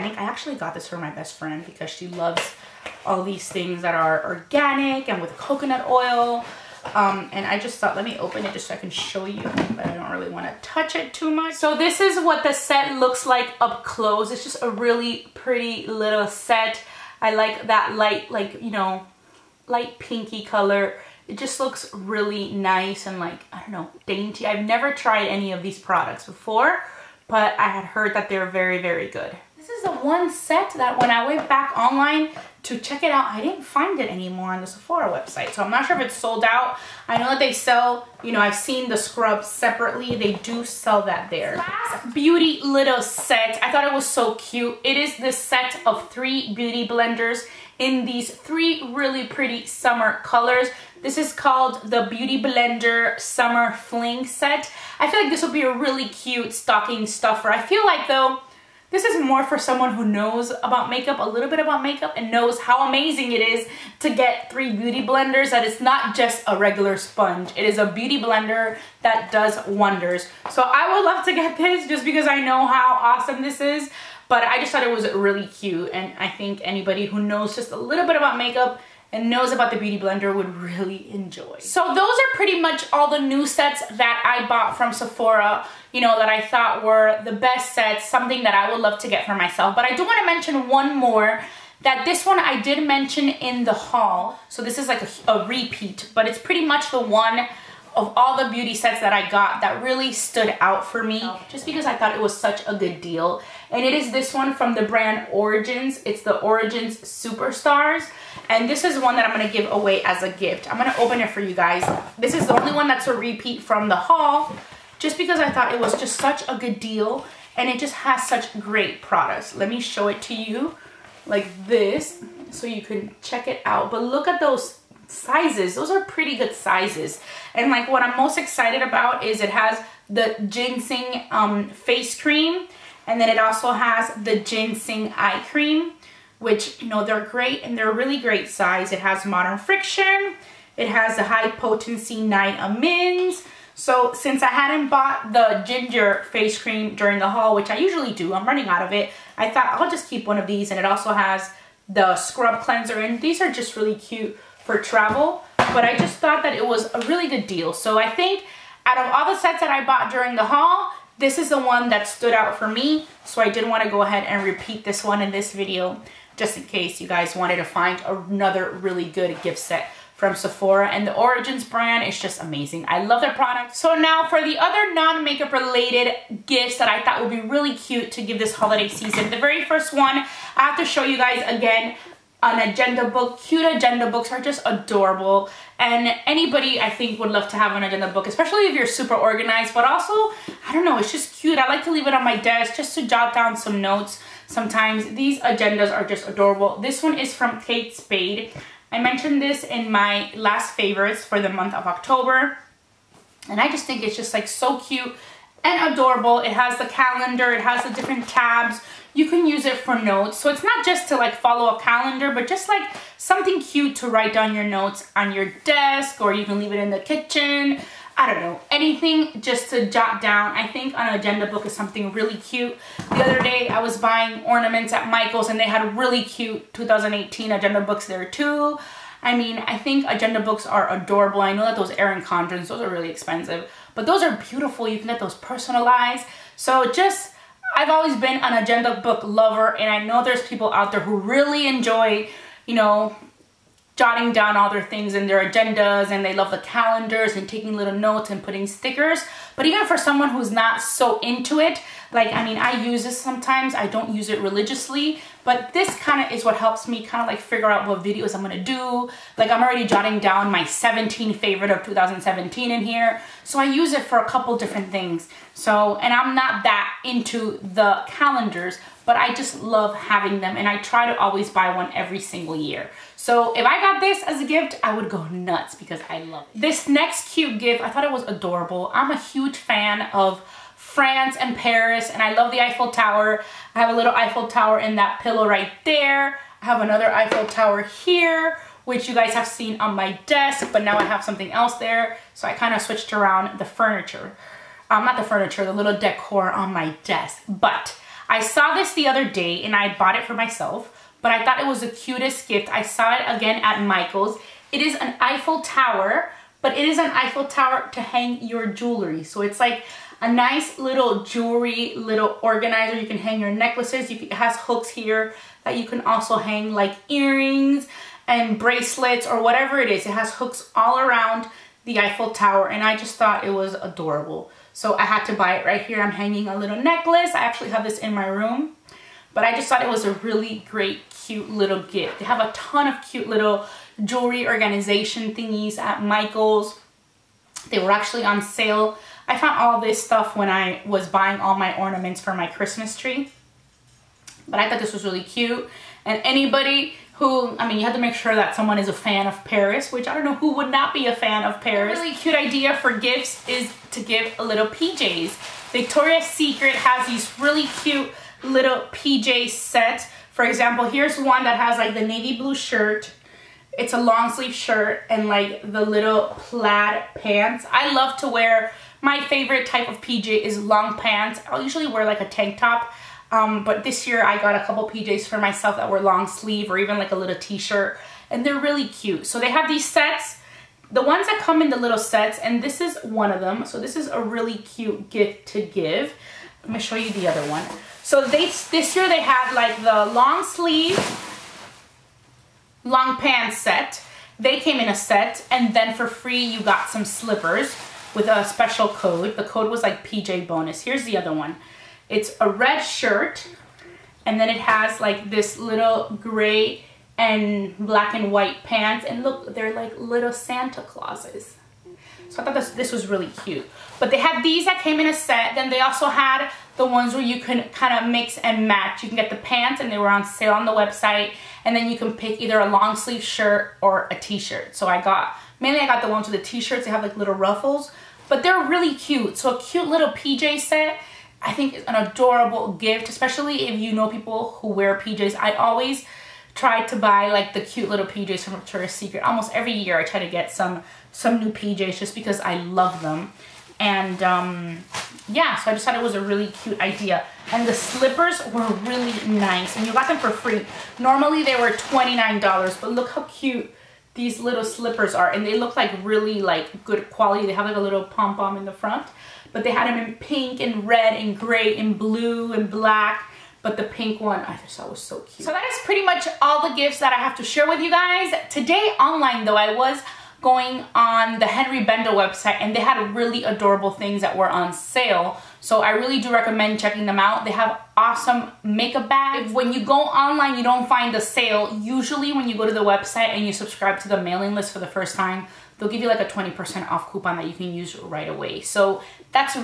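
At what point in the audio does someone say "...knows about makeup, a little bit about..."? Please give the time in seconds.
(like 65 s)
60 s.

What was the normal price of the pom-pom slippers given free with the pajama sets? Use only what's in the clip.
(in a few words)
$29.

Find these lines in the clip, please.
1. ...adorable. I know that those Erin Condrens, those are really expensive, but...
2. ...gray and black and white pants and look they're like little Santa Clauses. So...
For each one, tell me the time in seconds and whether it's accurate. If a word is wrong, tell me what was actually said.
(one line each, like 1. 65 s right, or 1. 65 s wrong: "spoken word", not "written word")
1. 230 s right
2. 406 s right.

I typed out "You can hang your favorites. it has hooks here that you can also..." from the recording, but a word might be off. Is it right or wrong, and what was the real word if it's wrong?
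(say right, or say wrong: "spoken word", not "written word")
wrong: "necklaces", not "favorites".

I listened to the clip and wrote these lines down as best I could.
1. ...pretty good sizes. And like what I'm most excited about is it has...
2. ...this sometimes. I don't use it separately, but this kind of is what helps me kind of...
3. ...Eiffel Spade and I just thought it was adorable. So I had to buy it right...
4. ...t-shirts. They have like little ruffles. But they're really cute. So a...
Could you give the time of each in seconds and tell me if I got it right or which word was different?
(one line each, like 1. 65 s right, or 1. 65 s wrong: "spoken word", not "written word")
1. 126 s right
2. 253 s wrong: "religiously", not "separately"
3. 321 s wrong: "Tower", not "Spade"
4. 426 s right.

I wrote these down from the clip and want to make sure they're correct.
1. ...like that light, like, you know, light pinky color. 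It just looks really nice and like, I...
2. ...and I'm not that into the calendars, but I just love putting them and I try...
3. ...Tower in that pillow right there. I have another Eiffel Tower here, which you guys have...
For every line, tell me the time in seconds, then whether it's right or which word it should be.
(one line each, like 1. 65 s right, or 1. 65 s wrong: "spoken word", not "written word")
1. 17 s right
2. 265 s wrong: "having", not "putting"
3. 284 s right.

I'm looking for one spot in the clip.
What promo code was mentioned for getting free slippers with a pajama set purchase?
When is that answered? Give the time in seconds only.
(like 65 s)
400 s.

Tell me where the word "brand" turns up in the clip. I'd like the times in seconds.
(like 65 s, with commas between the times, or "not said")
104 s, 171 s.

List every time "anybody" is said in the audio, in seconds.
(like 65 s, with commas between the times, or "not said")
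76 s, 186 s, 346 s.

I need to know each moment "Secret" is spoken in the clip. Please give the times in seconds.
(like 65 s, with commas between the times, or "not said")
356 s, 438 s.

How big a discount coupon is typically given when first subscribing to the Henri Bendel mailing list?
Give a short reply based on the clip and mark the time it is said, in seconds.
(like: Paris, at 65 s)
20%, at 486 s.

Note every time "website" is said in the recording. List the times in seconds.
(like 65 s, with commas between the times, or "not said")
35 s, 420 s, 472 s, 482 s.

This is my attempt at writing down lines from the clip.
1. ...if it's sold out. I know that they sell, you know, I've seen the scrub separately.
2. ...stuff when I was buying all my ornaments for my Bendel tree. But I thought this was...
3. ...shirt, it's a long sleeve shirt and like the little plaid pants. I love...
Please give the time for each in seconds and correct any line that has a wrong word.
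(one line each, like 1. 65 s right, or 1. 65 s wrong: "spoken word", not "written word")
1. 35 s right
2. 340 s wrong: "Christmas", not "Bendel"
3. 362 s right.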